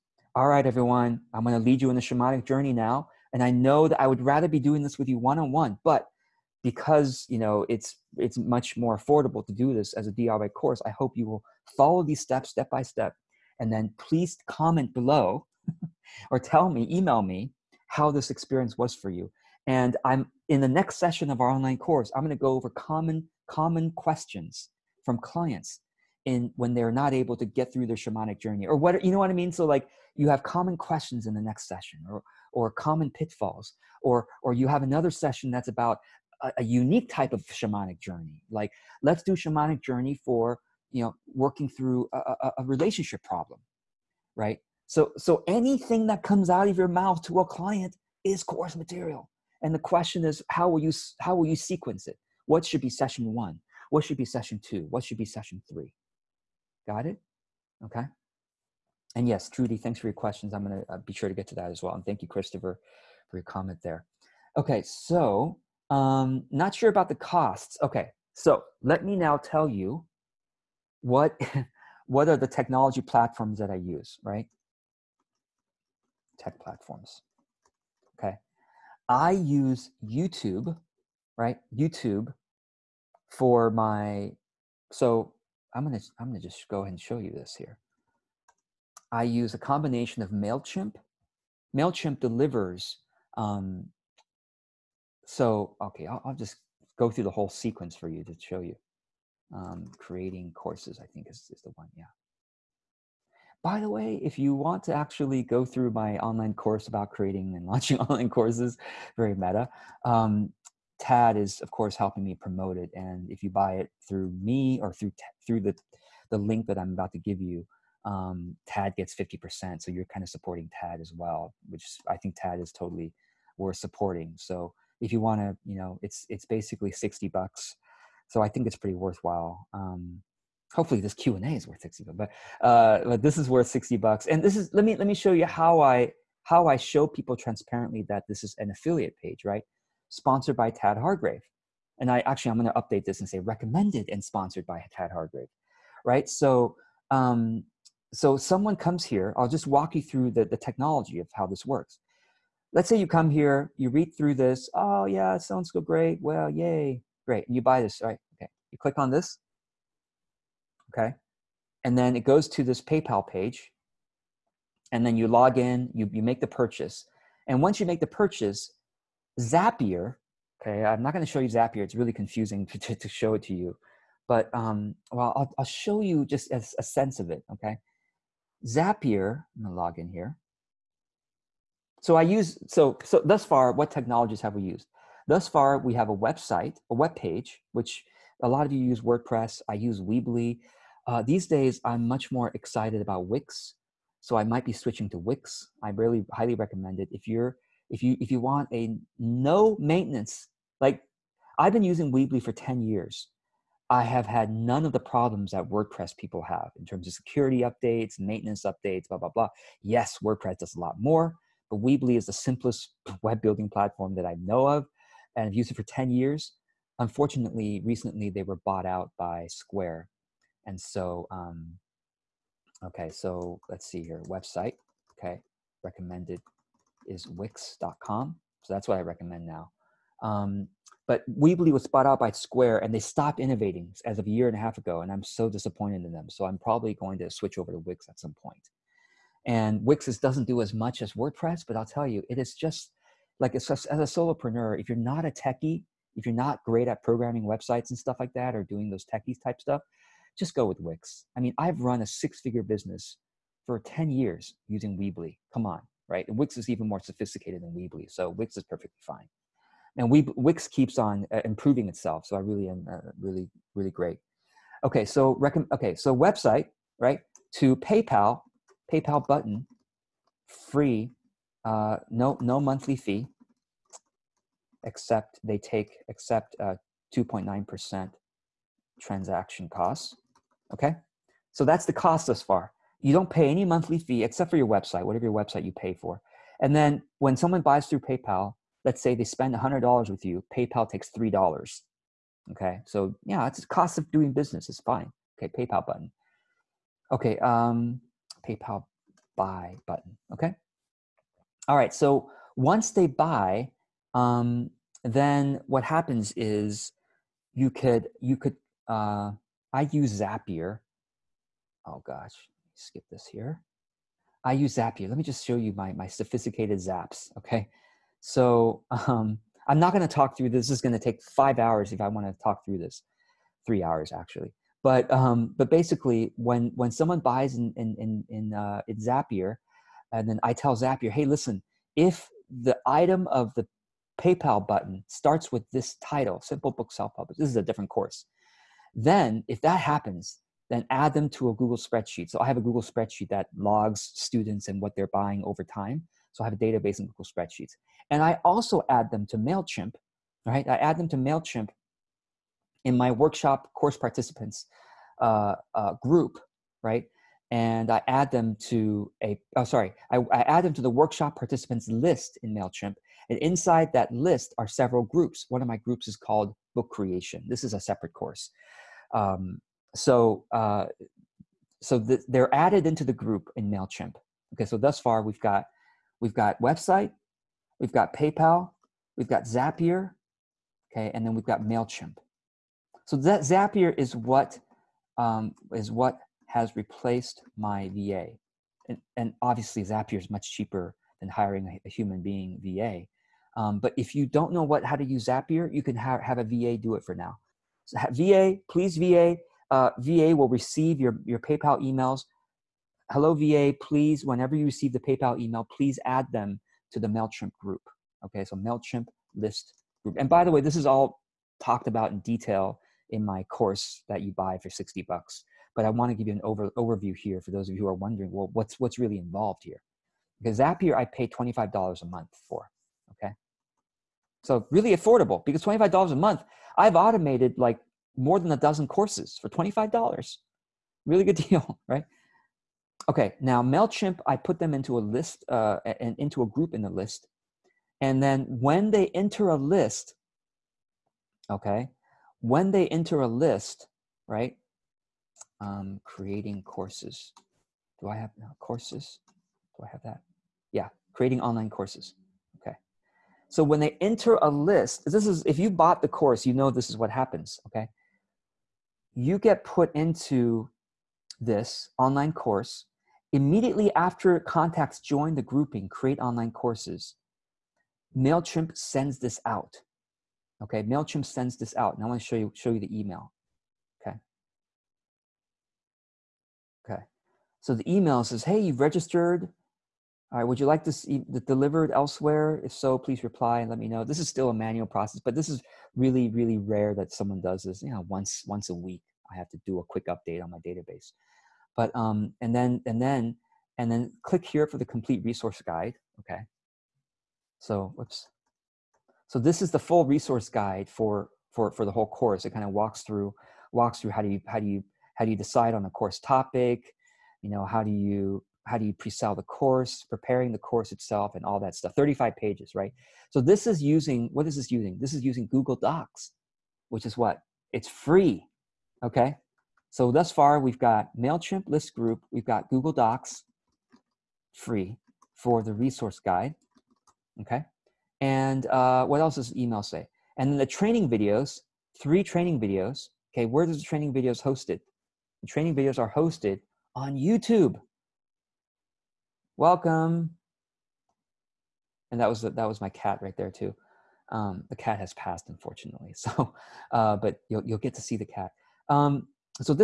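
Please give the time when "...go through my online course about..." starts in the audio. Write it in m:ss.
1:45.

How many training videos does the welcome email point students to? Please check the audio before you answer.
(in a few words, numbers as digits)
3.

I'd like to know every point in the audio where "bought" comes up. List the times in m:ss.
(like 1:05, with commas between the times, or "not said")
3:38, 3:51, 7:35.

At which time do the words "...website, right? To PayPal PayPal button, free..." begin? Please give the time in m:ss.
4:26.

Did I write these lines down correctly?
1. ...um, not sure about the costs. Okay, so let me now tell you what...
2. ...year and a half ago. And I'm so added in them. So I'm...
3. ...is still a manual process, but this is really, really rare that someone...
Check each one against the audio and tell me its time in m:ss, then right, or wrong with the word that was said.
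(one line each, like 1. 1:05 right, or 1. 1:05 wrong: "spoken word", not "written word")
1. 1:05 right
2. 3:54 wrong: "disappointed", not "added"
3. 8:04 right.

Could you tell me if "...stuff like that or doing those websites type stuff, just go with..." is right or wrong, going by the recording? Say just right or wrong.
wrong.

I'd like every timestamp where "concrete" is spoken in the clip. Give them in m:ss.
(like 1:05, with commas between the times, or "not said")
not said.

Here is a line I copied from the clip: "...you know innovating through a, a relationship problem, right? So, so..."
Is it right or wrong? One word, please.
wrong.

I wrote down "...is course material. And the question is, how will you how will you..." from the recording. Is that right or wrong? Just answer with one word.
right.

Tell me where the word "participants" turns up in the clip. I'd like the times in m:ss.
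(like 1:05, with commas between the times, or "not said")
5:53, 6:01.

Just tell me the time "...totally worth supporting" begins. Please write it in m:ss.
2:02.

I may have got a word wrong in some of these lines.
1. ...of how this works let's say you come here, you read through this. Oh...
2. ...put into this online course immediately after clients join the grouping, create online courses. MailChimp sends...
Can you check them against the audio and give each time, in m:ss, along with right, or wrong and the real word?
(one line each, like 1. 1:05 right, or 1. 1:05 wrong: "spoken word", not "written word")
1. 2:31 right
2. 7:39 wrong: "contacts", not "clients".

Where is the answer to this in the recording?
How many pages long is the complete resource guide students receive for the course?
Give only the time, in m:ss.
8:31.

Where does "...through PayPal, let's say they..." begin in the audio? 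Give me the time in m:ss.
4:47.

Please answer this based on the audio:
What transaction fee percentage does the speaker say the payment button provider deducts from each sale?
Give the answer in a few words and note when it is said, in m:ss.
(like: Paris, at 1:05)
2.9%, at 4:37.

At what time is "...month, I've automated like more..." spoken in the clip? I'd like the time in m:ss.
7:06.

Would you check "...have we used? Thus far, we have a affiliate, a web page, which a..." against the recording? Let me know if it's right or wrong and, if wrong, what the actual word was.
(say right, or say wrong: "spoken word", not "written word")
wrong: "website", not "affiliate".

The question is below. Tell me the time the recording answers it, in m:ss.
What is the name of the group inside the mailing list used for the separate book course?
6:06.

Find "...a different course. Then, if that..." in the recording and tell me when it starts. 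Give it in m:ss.
5:37.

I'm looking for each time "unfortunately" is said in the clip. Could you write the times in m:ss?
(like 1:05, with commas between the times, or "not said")
3:36, 9:05.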